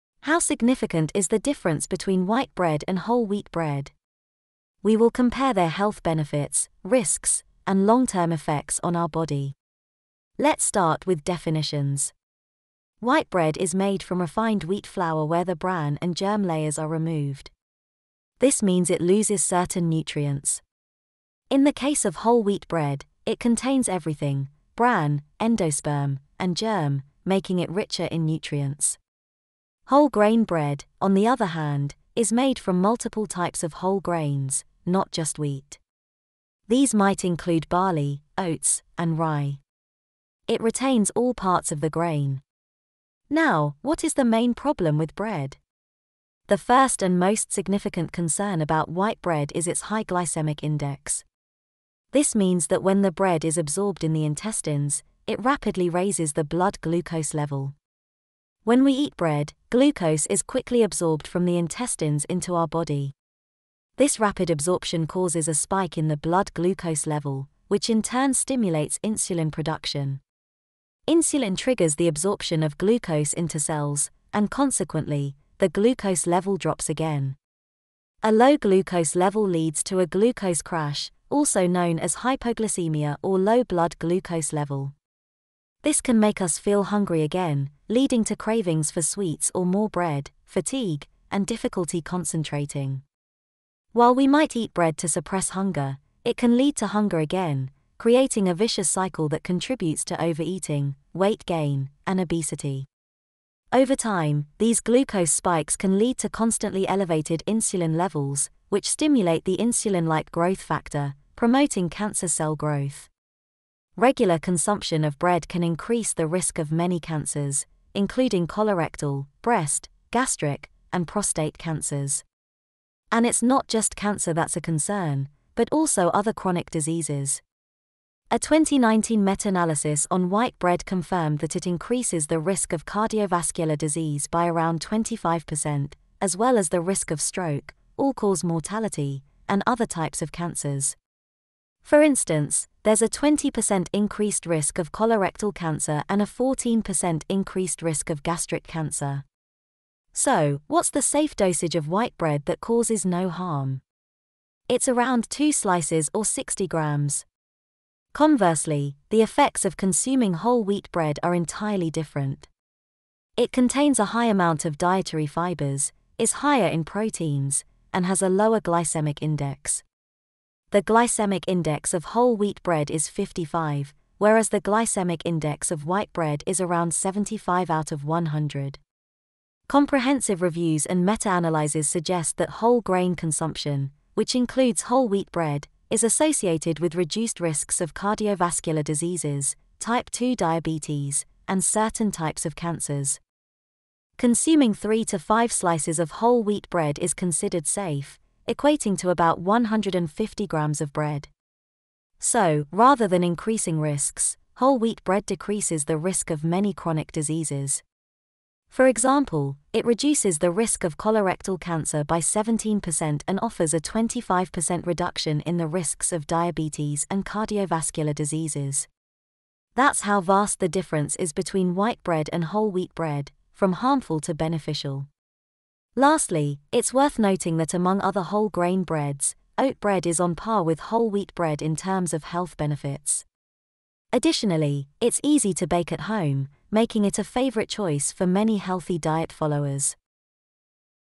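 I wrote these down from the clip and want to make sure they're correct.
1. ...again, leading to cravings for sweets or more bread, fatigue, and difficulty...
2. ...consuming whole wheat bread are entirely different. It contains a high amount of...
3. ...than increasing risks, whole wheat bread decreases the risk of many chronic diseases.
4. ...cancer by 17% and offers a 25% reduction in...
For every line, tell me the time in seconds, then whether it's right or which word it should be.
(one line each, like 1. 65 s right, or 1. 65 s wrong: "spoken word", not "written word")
1. 87 s right
2. 159 s right
3. 203 s right
4. 211 s right.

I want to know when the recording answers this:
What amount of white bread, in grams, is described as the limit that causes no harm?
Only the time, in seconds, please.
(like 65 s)
156 s.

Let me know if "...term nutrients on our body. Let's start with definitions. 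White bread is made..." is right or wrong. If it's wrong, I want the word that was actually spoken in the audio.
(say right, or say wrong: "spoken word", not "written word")
wrong: "effects", not "nutrients".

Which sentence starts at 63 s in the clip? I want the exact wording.
This rapid absorption causes a spike in the blood glucose level, which in turn stimulates insulin production.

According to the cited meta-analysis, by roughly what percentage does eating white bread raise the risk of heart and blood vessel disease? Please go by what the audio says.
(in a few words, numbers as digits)
25%.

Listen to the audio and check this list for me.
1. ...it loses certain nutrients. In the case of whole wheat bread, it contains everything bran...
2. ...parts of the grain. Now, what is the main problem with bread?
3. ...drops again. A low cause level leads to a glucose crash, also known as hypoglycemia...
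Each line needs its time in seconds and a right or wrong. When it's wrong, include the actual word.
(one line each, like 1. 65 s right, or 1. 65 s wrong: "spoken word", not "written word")
1. 18 s right
2. 41 s right
3. 76 s wrong: "glucose", not "cause".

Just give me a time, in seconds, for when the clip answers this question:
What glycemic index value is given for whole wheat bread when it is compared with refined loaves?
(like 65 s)
173 s.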